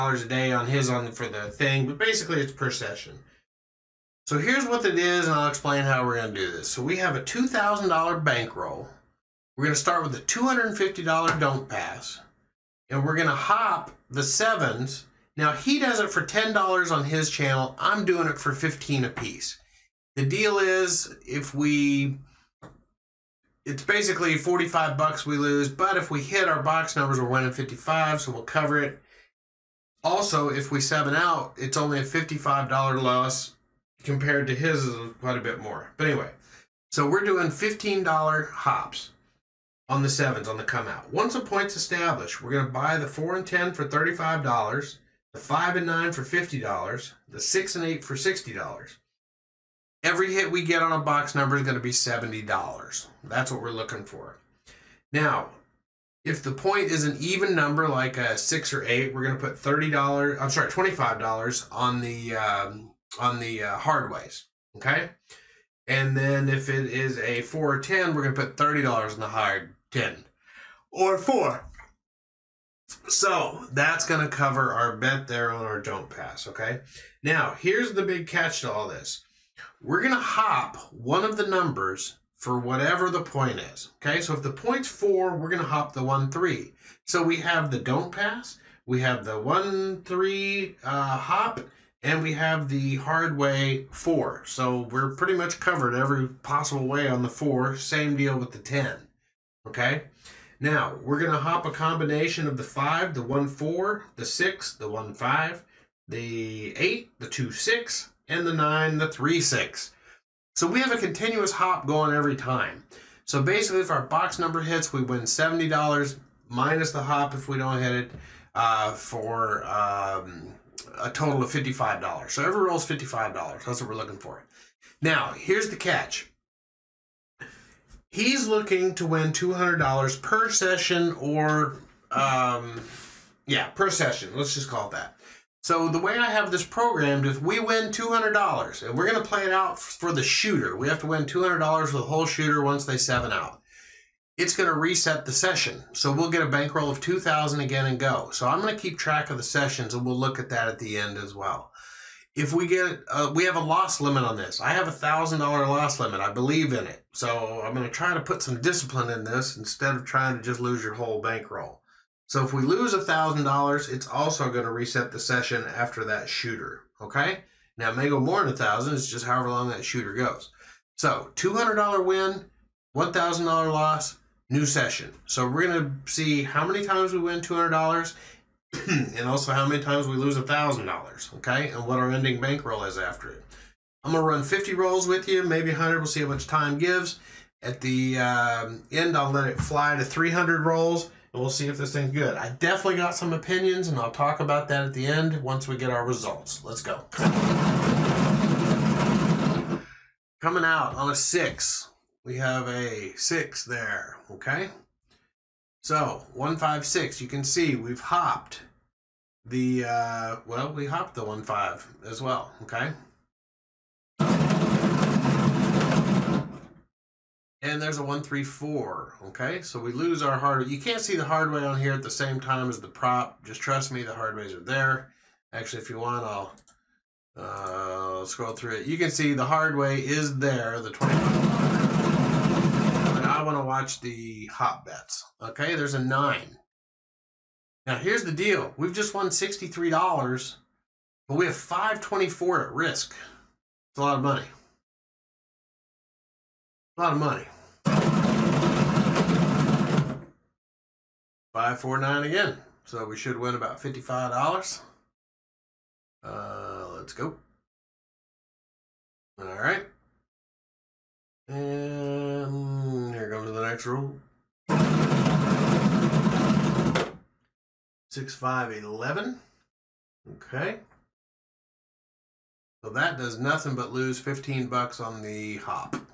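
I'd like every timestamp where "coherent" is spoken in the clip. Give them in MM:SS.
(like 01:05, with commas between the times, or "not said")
not said.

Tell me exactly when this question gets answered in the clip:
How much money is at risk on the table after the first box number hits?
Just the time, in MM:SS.
04:01.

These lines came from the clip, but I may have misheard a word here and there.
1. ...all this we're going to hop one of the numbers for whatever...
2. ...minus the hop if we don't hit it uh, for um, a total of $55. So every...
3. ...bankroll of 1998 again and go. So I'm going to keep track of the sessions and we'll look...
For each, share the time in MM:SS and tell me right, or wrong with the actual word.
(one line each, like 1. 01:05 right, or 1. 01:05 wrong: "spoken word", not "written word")
1. 01:18 right
2. 01:56 right
3. 02:26 wrong: "2000", not "1998".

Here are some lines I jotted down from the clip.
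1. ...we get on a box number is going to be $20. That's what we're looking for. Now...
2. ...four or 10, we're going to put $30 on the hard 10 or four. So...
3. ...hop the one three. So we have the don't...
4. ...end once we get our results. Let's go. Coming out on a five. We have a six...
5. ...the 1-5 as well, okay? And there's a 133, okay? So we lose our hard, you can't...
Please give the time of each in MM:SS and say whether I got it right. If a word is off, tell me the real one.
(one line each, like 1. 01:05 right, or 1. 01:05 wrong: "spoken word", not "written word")
1. 00:50 wrong: "70", not "20"
2. 01:07 right
3. 01:25 right
4. 03:15 wrong: "six", not "five"
5. 03:31 wrong: "134", not "133".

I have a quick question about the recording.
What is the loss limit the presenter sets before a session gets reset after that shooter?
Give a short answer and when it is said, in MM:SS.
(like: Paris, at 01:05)
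$1,000, at 02:34.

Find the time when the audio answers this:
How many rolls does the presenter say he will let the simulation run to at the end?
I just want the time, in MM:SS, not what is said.
03:10.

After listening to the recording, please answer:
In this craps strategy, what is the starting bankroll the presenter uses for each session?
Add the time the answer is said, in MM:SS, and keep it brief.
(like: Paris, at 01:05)
$2,000, at 00:07.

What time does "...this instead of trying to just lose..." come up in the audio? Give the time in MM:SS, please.
02:39.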